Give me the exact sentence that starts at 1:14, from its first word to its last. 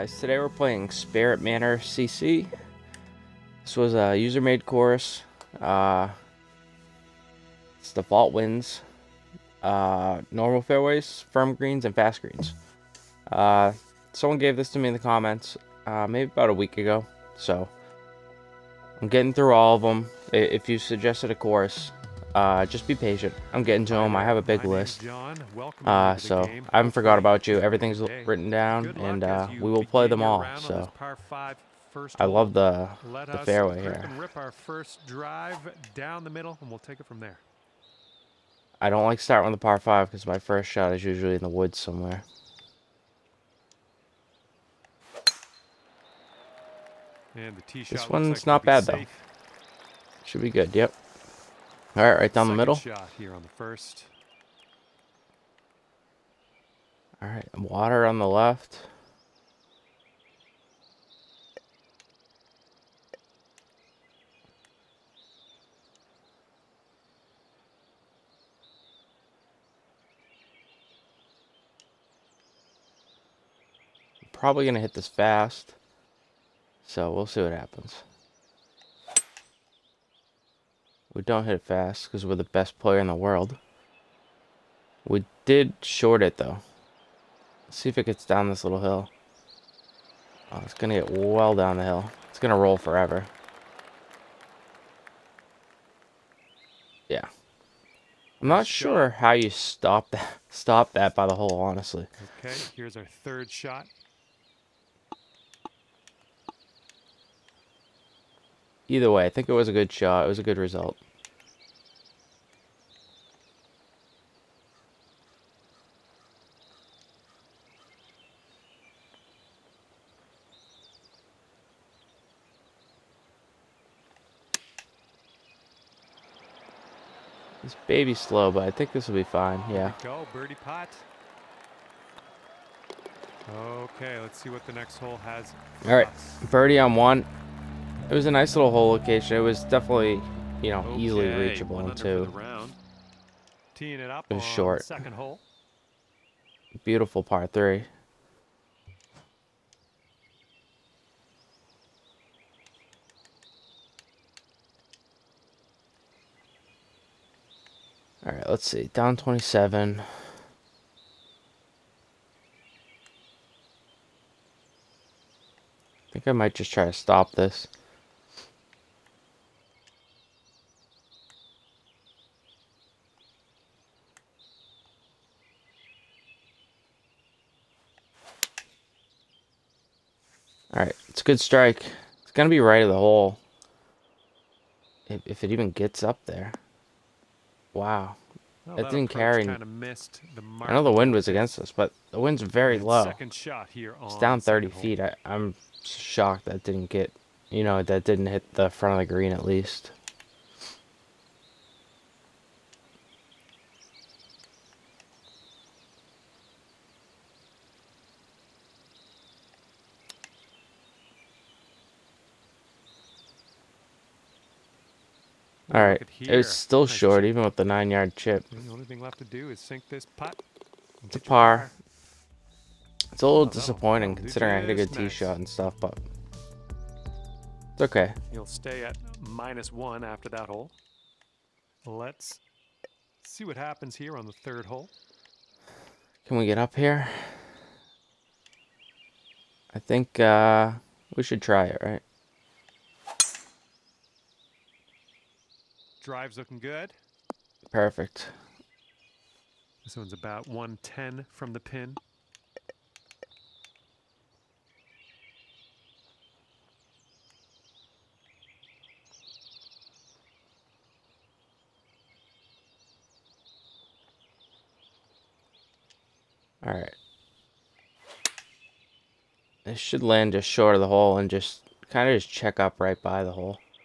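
probably going to hit this fast.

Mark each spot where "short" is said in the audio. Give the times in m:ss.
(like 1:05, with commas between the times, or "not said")
1:25, 2:24, 3:36, 4:30.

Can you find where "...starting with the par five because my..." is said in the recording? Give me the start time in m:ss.
0:39.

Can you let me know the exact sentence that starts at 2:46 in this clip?
I think I might just try to stop this.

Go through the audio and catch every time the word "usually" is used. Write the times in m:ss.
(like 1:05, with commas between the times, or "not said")
0:41.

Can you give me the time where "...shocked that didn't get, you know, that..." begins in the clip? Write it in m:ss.
3:15.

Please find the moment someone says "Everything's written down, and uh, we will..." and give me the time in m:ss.
0:27.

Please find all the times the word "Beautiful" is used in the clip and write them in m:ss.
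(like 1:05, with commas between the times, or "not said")
2:26.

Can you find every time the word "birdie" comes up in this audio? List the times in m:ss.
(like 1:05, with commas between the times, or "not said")
2:10, 2:16.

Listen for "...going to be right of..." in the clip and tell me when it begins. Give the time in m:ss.
3:02.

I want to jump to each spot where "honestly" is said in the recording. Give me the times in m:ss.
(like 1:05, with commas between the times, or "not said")
1:41.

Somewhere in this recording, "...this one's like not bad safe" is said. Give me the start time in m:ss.
0:47.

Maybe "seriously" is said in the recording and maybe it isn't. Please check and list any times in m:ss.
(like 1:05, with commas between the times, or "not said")
not said.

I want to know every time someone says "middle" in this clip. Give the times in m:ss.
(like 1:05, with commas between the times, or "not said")
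0:36, 0:52.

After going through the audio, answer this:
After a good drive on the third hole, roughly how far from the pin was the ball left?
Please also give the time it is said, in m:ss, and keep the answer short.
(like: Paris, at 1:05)
110, at 4:10.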